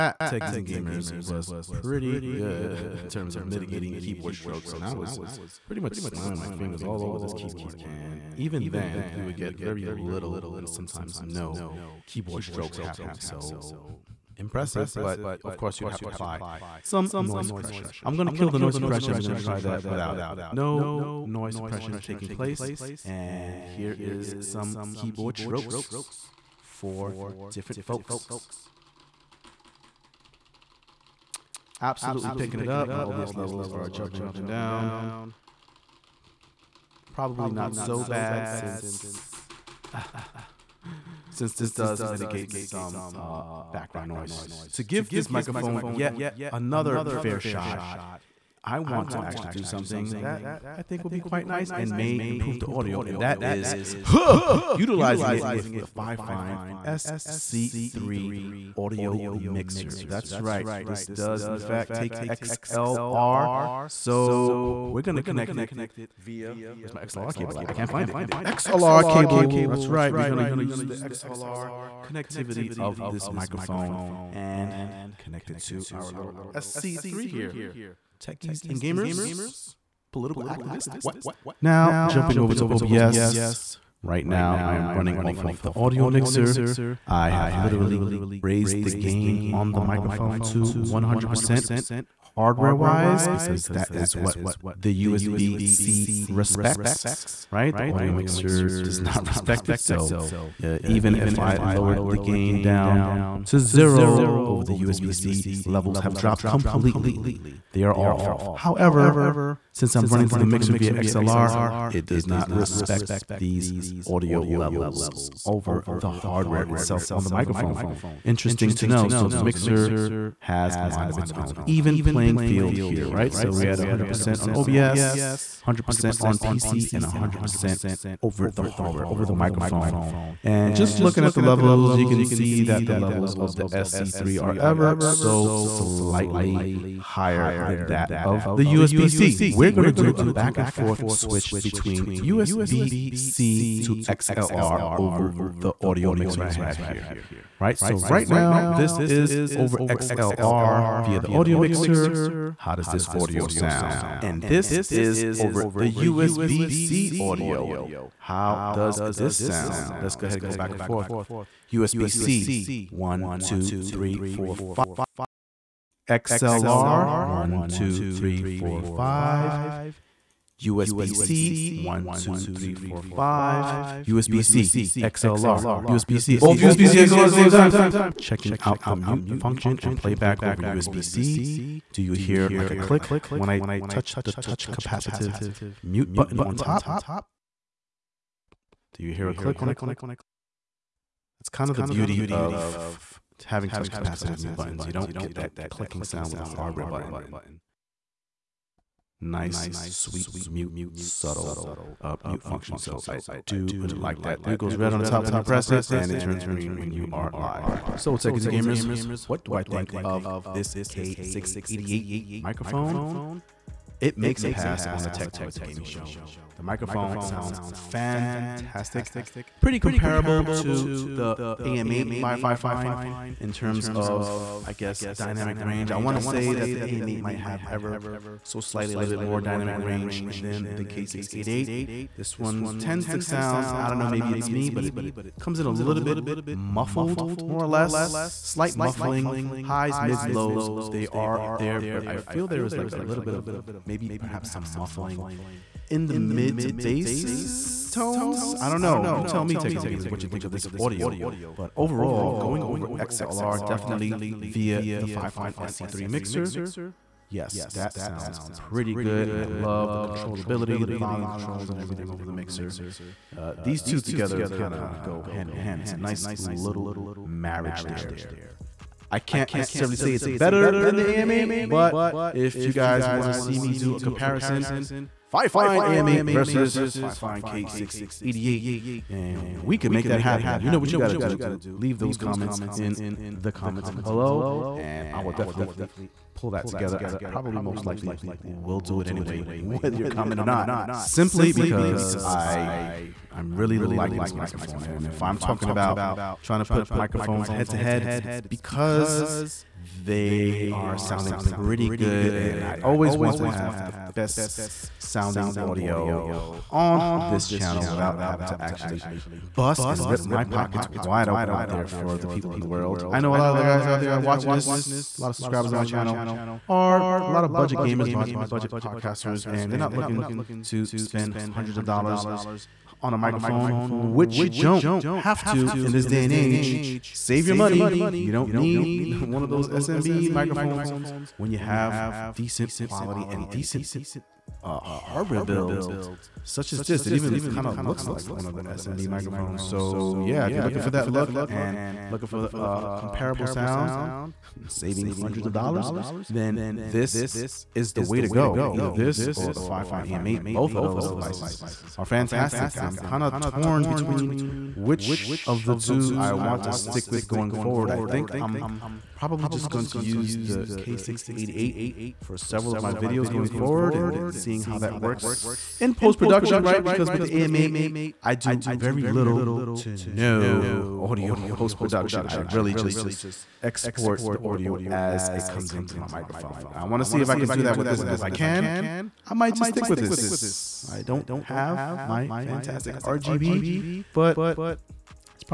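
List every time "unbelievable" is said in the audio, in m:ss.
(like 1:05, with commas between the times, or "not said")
not said.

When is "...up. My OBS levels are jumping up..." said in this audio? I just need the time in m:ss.
0:32.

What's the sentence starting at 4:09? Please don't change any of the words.
You tell me, Techers Gamers, what you think of this audio.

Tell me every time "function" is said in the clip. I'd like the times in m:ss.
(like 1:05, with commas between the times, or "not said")
2:59, 3:22.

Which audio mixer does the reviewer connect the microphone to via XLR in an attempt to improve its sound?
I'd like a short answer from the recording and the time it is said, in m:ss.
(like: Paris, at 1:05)
Fifine SC3, at 0:55.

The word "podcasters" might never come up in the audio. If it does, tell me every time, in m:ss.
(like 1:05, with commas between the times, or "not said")
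5:18.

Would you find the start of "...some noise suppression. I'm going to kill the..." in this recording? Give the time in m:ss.
0:16.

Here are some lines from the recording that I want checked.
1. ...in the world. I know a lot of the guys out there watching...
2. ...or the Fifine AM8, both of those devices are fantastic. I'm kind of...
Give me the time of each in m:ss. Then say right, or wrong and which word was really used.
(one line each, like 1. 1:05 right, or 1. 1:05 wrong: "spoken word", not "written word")
1. 5:12 right
2. 5:49 right.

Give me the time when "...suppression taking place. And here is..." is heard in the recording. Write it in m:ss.
0:21.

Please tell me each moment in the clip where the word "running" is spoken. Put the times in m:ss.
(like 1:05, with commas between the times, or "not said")
1:24, 1:50.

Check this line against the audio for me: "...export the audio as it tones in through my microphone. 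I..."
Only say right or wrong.
wrong.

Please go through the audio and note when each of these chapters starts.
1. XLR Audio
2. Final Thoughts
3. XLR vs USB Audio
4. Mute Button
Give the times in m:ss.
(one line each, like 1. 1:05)
1. 0:44
2. 3:27
3. 2:19
4. 2:58.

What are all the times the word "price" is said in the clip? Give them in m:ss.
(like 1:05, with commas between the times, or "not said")
not said.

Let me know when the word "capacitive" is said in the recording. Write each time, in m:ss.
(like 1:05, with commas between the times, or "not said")
3:04, 3:13.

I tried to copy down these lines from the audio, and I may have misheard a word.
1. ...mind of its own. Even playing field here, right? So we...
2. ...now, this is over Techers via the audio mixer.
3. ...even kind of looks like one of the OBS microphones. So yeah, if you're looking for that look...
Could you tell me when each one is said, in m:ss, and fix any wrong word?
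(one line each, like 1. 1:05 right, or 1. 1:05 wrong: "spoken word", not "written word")
1. 2:00 right
2. 2:28 wrong: "XLR", not "Techers"
3. 5:37 wrong: "SMB", not "OBS".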